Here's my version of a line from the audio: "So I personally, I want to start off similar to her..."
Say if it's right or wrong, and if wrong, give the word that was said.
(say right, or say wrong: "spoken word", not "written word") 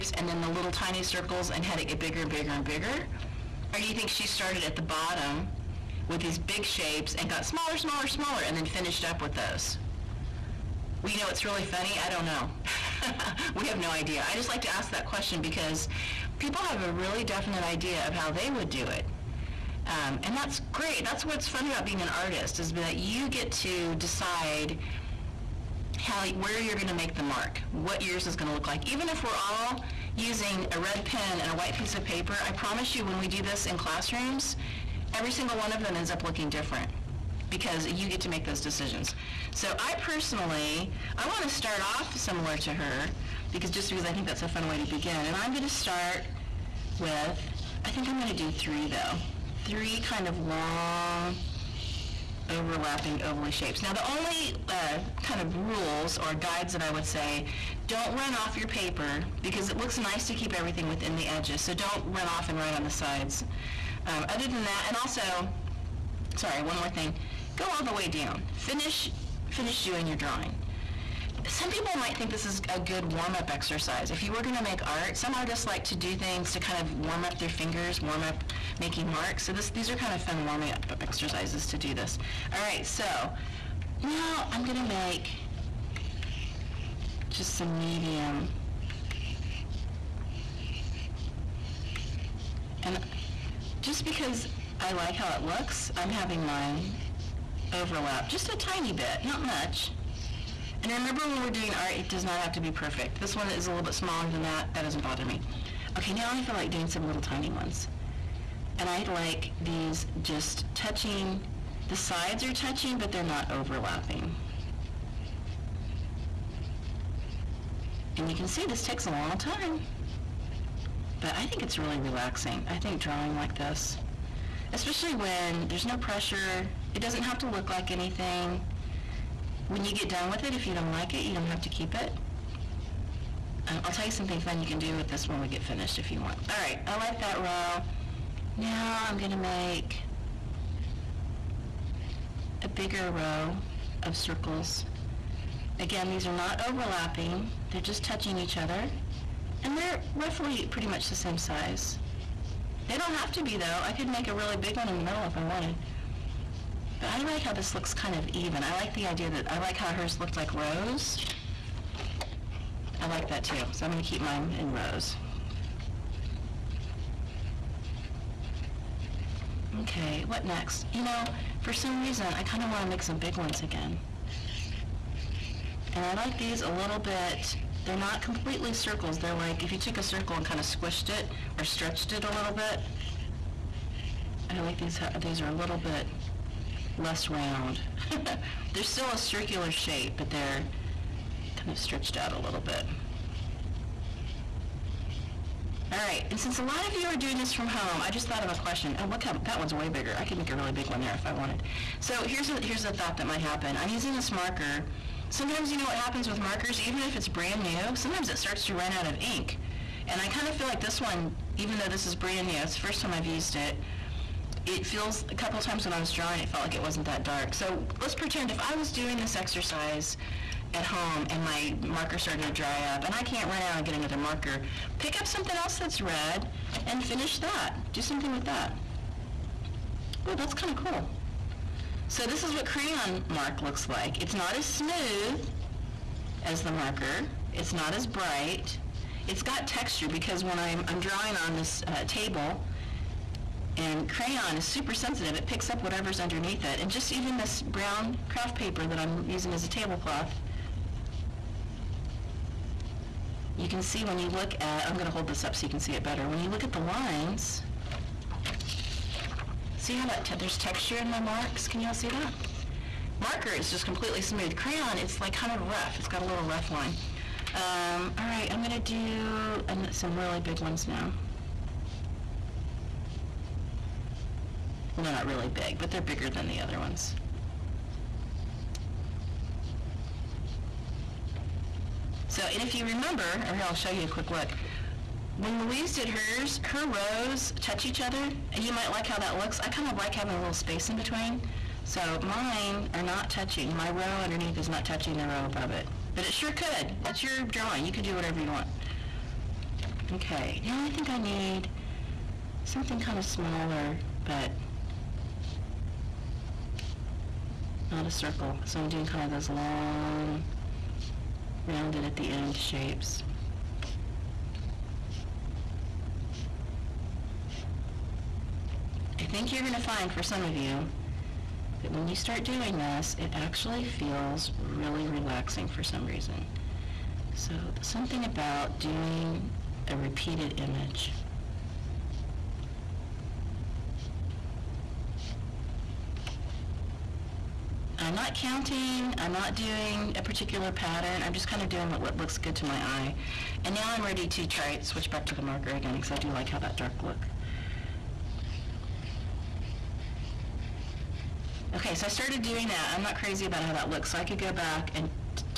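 right.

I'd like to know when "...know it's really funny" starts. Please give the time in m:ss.
0:11.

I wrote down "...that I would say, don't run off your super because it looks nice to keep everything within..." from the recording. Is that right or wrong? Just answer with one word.
wrong.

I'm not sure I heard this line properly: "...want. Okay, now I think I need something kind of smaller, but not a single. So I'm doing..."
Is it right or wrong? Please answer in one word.
wrong.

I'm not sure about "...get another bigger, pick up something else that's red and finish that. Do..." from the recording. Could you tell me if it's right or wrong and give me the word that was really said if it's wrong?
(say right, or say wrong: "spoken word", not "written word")
wrong: "marker", not "bigger".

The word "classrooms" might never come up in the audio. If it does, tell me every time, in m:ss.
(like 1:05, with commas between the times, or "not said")
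0:33.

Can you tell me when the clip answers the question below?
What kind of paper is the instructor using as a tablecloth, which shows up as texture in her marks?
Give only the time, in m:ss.
4:07.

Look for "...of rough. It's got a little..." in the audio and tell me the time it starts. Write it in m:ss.
4:25.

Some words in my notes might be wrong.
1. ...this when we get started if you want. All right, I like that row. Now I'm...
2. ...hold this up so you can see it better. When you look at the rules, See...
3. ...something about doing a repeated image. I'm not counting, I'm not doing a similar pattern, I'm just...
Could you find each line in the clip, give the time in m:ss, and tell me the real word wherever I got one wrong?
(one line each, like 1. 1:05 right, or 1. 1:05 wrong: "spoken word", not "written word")
1. 2:15 wrong: "finished", not "started"
2. 4:15 wrong: "lines", not "rules"
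3. 5:27 wrong: "particular", not "similar".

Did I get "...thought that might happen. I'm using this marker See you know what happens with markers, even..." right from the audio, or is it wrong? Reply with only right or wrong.
wrong.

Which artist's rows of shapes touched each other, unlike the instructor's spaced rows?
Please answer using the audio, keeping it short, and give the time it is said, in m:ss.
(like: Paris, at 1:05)
Louise, at 4:45.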